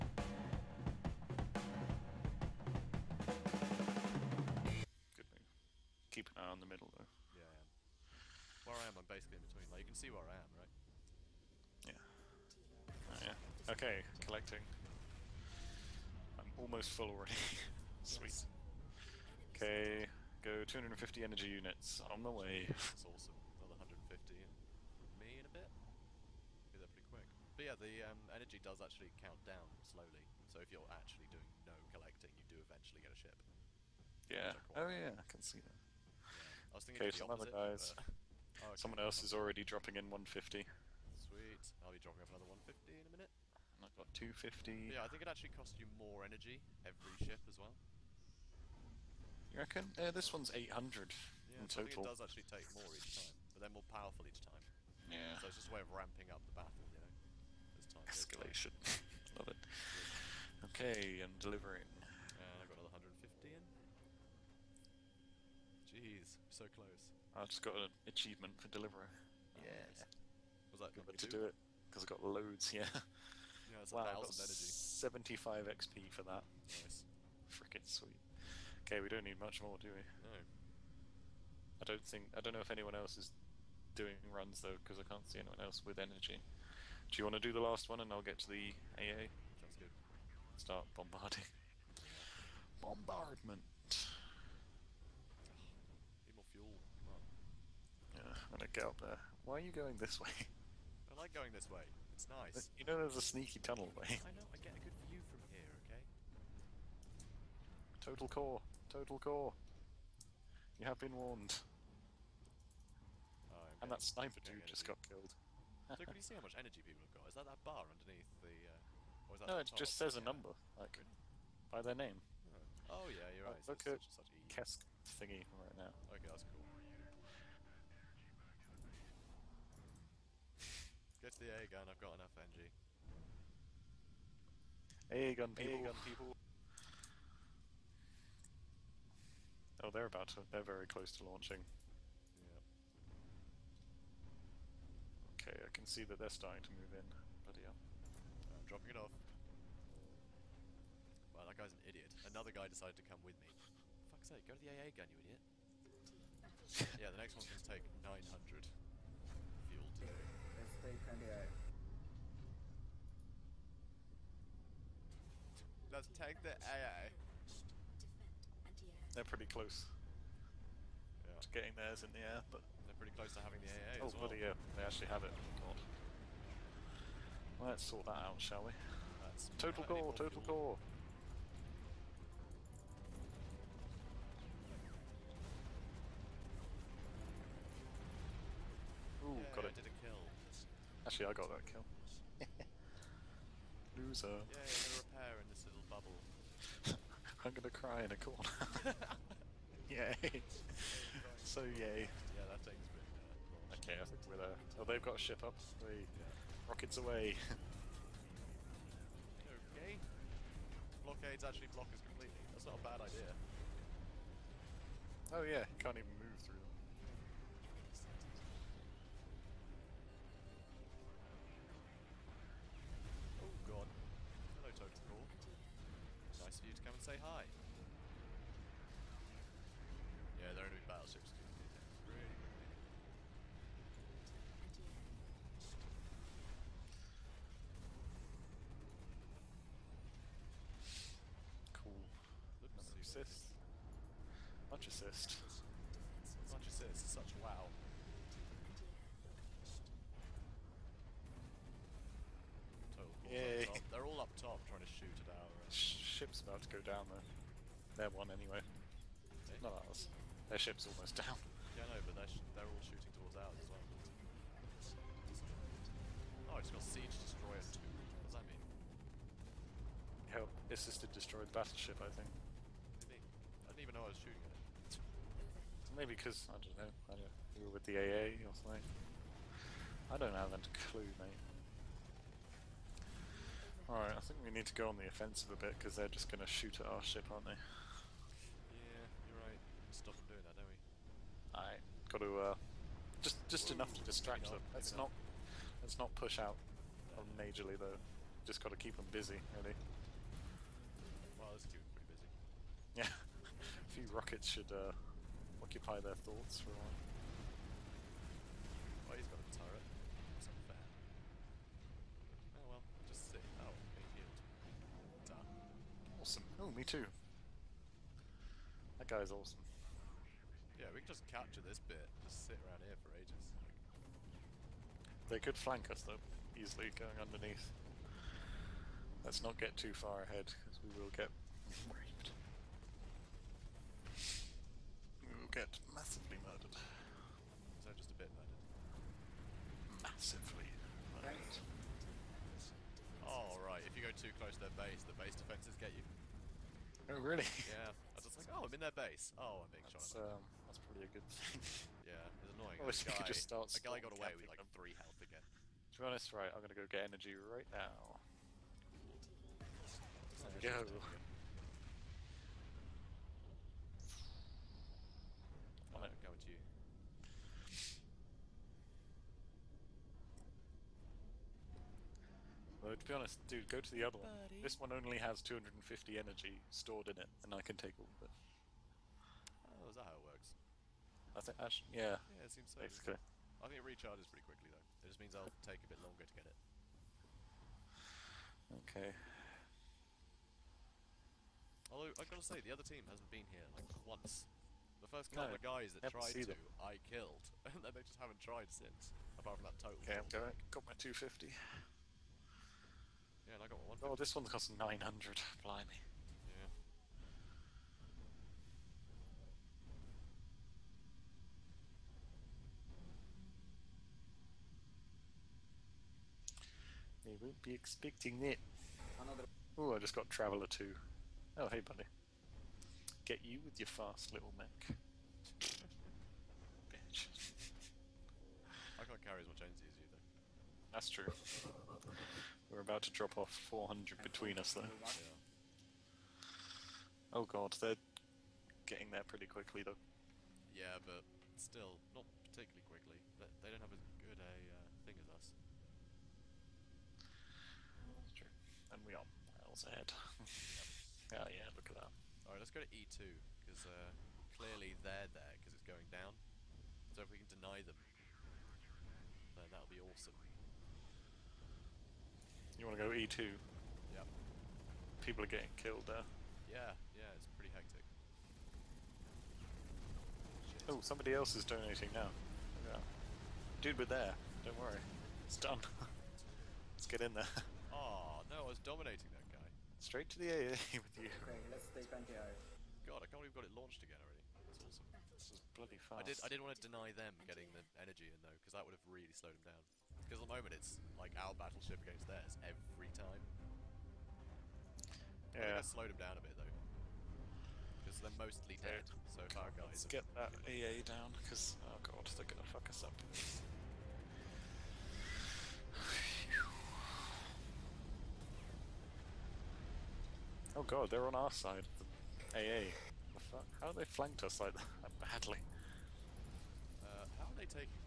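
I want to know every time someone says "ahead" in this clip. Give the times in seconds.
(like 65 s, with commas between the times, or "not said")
330 s, 449 s.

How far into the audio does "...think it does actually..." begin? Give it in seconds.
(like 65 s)
51 s.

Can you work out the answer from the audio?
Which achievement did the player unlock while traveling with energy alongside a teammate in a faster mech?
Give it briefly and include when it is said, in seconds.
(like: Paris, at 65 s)
Traveller 2, at 420 s.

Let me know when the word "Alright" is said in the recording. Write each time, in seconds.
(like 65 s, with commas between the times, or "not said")
283 s, 291 s, 452 s.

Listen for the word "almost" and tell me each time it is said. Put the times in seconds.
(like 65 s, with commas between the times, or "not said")
16 s, 260 s.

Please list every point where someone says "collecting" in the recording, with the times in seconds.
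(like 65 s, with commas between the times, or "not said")
14 s, 31 s.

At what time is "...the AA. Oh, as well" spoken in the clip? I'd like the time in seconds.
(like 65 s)
173 s.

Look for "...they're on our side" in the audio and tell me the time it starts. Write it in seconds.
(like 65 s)
511 s.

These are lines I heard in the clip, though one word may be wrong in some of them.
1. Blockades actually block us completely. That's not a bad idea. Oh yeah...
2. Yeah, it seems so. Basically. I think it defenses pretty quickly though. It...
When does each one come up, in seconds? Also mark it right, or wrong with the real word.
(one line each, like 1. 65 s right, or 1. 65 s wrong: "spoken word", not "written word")
1. 211 s right
2. 382 s wrong: "recharges", not "defenses".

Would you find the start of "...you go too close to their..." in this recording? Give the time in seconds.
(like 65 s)
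343 s.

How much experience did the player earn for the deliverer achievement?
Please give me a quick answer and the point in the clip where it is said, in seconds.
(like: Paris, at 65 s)
75 XP, at 74 s.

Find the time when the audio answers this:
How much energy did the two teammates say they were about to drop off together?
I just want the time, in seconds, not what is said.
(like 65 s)
433 s.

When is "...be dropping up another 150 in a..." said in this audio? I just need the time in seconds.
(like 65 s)
41 s.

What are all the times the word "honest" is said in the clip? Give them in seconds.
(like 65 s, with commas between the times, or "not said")
356 s, 373 s.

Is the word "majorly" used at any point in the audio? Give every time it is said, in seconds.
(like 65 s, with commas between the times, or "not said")
297 s.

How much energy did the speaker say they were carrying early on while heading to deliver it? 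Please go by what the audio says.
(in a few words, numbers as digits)
250.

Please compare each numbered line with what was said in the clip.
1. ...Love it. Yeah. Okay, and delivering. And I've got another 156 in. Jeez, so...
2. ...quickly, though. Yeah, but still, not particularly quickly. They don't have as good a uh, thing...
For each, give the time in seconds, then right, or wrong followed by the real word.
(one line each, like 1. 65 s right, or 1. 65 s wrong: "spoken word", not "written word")
1. 59 s wrong: "150", not "156"
2. 439 s right.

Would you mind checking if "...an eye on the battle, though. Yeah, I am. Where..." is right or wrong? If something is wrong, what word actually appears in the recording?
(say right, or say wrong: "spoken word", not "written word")
wrong: "middle", not "battle".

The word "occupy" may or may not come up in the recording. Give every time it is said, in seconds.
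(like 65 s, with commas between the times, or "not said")
305 s.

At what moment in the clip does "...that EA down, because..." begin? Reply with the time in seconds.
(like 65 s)
500 s.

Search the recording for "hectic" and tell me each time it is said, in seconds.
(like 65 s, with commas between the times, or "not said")
467 s.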